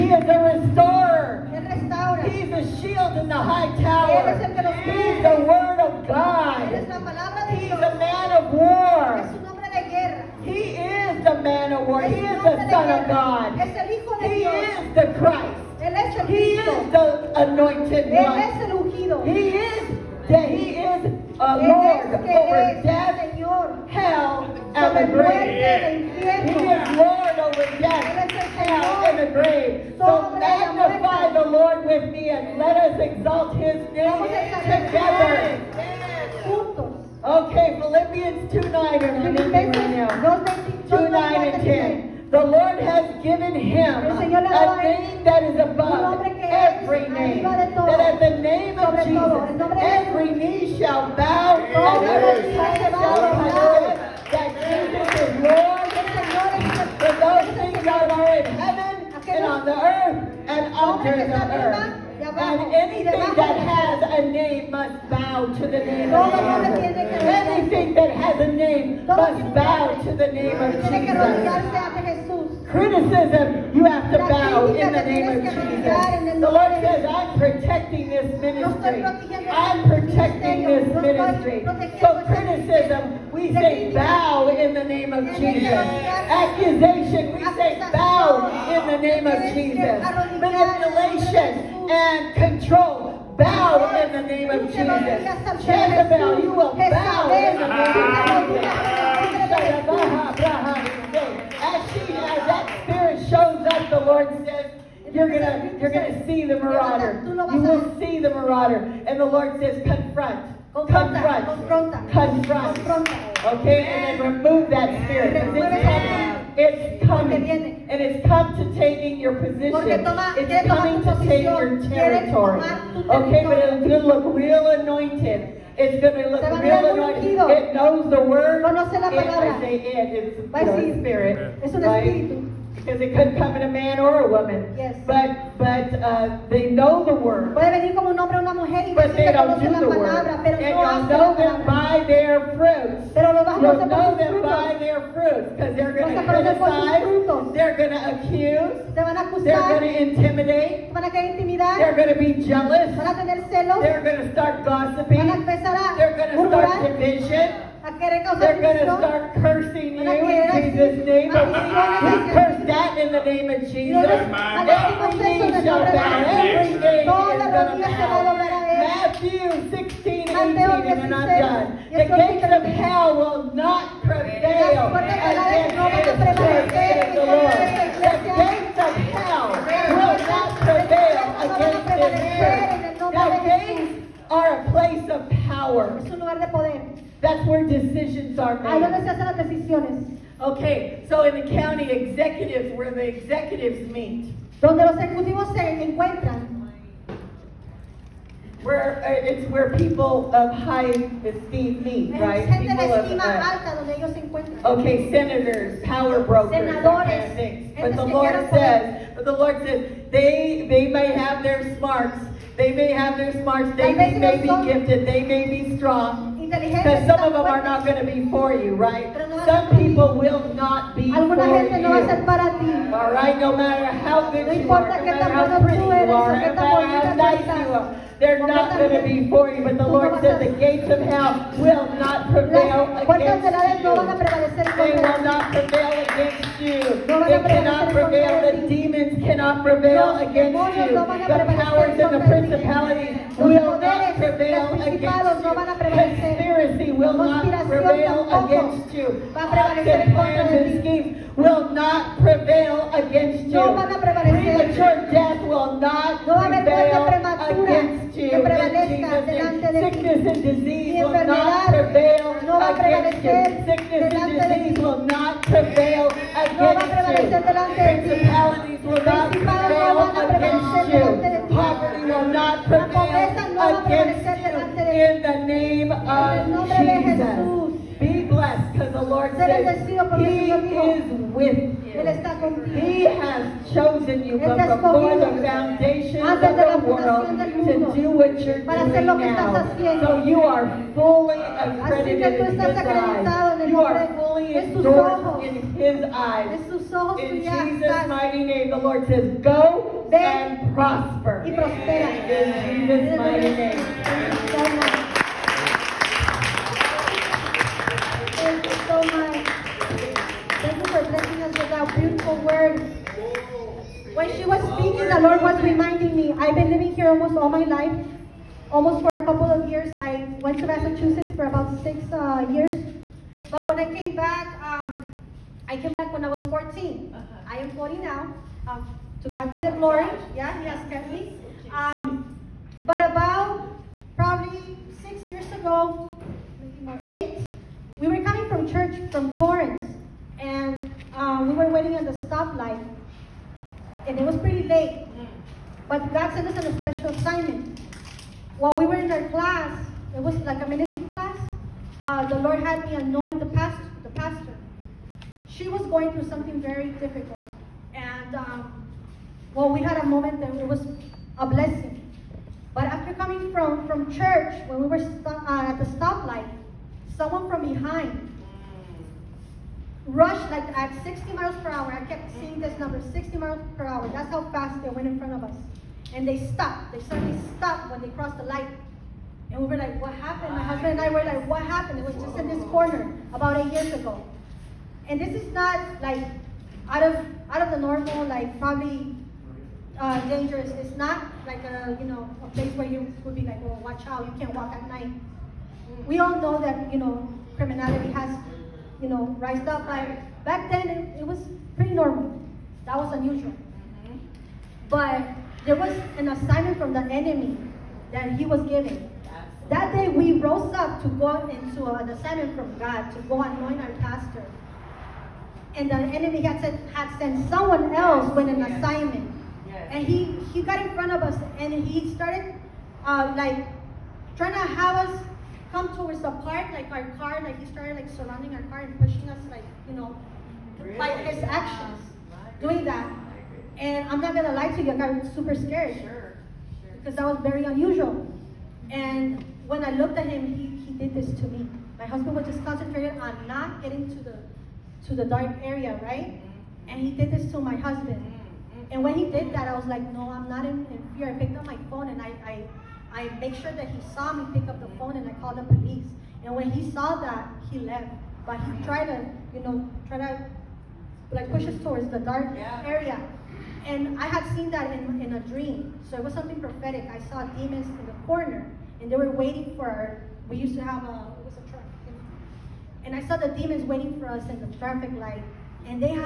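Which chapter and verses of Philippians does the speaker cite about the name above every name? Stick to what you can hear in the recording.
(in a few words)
2:9-10.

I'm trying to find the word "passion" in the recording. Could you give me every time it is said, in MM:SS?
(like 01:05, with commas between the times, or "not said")
not said.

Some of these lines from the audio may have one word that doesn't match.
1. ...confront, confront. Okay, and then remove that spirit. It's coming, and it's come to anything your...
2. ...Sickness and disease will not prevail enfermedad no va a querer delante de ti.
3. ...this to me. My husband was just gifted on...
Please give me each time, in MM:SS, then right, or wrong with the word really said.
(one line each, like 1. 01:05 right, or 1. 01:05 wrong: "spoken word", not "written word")
1. 01:50 wrong: "taking", not "anything"
2. 04:18 wrong: "prevalecer", not "querer"
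3. 07:21 wrong: "concentrated", not "gifted".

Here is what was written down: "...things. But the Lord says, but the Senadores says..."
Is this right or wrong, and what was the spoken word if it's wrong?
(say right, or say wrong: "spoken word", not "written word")
wrong: "Lord", not "Senadores".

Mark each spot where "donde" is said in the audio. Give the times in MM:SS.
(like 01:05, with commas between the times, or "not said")
03:08, 03:14, 03:23.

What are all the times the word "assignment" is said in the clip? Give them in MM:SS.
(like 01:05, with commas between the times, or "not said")
05:47, 06:46, 06:52, 06:58.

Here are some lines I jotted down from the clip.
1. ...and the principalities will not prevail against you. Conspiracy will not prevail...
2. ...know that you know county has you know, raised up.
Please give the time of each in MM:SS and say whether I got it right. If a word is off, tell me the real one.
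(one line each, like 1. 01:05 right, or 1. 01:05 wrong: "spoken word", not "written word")
1. 04:01 right
2. 06:36 wrong: "criminality", not "county".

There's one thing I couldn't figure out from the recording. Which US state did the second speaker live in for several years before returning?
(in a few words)
Massachusetts.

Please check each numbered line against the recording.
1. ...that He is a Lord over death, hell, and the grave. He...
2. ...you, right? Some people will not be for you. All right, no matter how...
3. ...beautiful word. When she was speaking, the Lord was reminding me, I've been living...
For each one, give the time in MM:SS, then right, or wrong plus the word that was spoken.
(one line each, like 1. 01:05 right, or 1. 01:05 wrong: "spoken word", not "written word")
1. 00:20 right
2. 03:38 right
3. 05:11 right.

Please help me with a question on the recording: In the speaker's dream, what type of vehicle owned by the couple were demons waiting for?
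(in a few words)
A truck.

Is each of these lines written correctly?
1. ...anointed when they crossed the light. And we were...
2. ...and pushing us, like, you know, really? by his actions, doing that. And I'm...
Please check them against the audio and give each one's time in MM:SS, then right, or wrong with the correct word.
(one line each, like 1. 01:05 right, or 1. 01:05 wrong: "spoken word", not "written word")
1. 06:17 wrong: "stopped", not "anointed"
2. 07:08 right.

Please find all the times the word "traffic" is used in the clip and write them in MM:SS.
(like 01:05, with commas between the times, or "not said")
07:54.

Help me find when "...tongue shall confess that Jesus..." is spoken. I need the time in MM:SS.
00:52.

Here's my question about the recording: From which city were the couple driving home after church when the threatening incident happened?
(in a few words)
Torrance.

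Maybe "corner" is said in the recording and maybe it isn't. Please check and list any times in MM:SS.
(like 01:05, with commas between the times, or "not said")
06:22, 07:48.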